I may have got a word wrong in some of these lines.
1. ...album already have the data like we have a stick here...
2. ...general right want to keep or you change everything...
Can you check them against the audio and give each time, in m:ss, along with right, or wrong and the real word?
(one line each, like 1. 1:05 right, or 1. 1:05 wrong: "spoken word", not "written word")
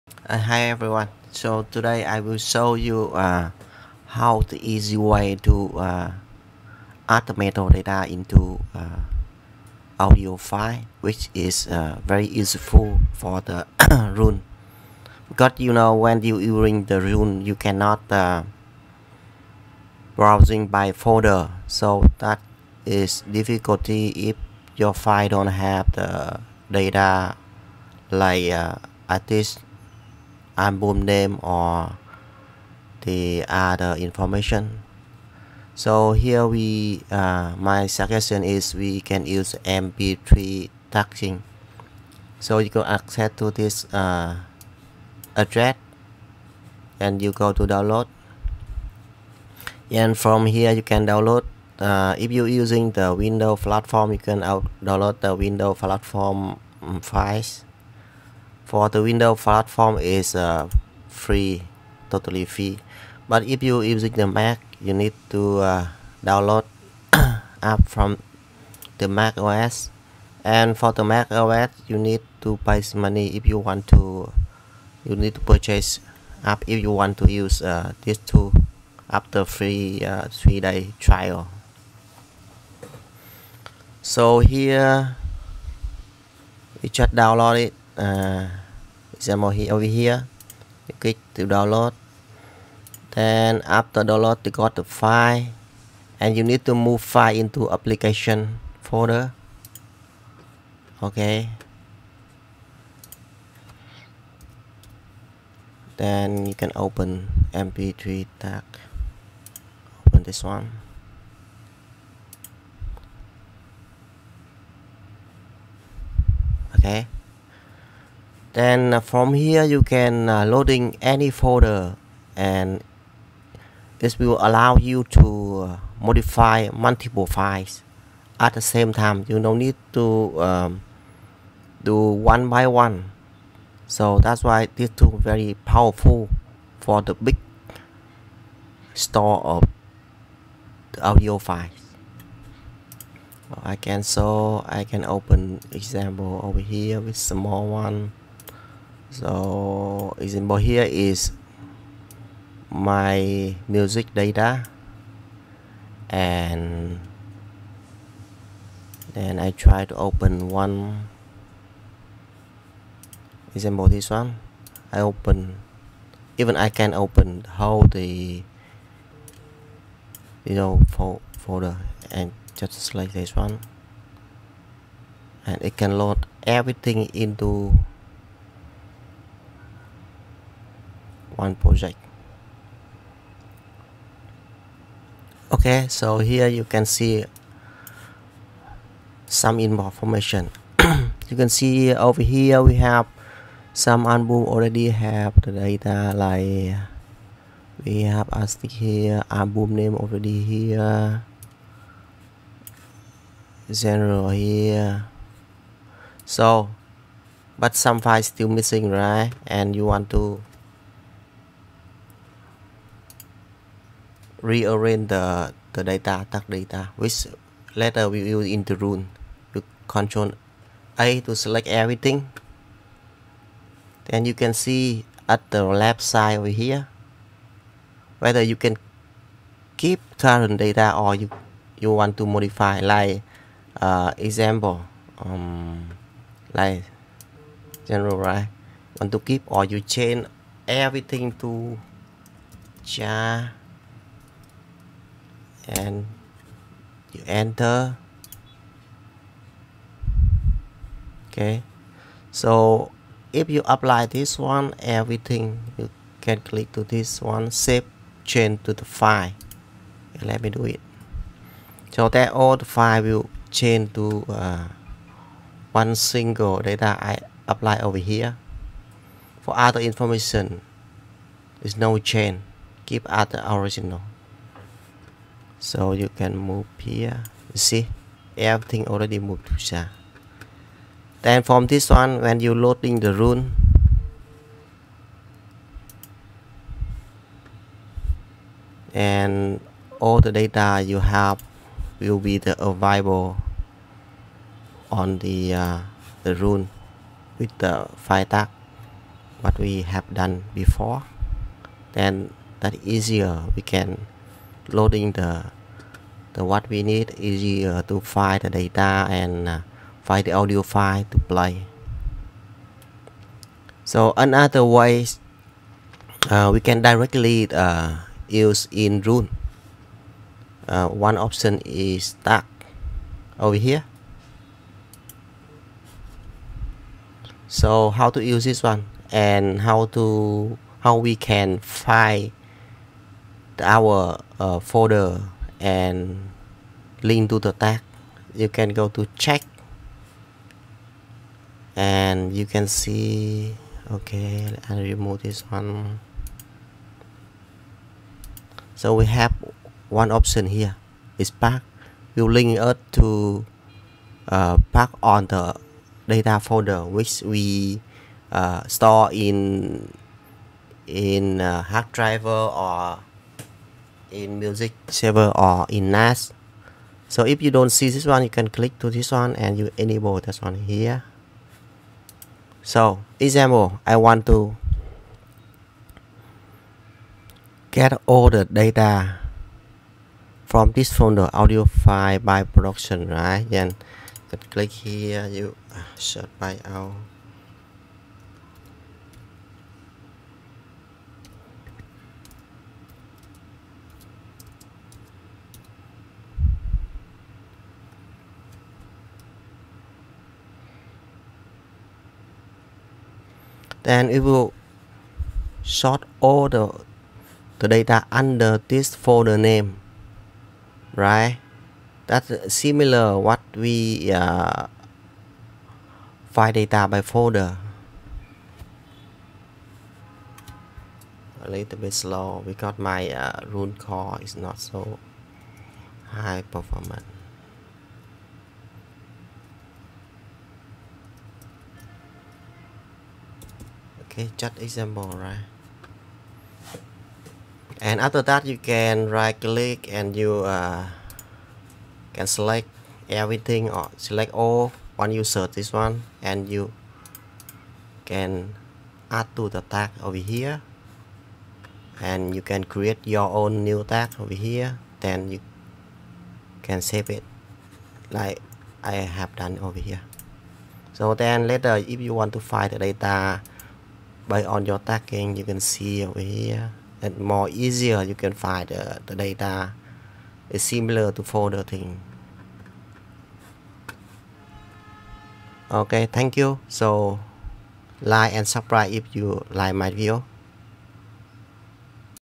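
1. 3:14 right
2. 3:57 right.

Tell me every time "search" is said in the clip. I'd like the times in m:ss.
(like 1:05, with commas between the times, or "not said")
6:25, 7:25.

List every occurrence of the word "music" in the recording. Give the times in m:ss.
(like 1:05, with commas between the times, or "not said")
2:33, 6:04.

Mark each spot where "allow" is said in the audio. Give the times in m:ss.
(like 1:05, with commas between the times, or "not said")
2:04.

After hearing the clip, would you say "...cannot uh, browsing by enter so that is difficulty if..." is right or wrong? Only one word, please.
wrong.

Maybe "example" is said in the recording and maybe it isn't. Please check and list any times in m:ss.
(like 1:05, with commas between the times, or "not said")
1:29, 2:25, 2:30, 2:43, 3:54, 6:13, 7:14.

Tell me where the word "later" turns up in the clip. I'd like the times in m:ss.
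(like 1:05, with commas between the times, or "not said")
3:37, 7:41.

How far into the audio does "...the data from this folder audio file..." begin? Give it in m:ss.
6:18.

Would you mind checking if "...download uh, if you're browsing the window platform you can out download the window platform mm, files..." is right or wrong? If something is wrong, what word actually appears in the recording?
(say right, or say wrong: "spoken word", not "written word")
wrong: "using", not "browsing".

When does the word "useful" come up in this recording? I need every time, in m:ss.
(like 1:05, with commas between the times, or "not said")
0:12.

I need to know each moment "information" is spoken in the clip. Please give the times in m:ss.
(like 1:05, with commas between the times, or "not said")
0:33, 3:09, 4:29.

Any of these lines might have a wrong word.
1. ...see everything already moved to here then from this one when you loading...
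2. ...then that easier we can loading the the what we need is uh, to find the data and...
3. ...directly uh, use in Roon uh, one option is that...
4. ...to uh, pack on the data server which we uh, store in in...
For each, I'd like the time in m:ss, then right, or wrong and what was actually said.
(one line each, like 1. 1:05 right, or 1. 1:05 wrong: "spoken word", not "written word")
1. 4:37 right
2. 5:01 right
3. 5:16 right
4. 5:52 wrong: "folder", not "server".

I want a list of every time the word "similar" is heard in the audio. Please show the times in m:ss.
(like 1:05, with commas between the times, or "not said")
6:52, 7:50.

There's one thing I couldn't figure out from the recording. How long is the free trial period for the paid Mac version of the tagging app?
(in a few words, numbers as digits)
3 days.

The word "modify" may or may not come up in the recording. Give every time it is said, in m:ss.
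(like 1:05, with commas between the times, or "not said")
2:06, 3:52.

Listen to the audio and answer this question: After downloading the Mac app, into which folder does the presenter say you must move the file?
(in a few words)
Application folder.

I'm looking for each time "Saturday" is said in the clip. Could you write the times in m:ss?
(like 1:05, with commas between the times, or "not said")
not said.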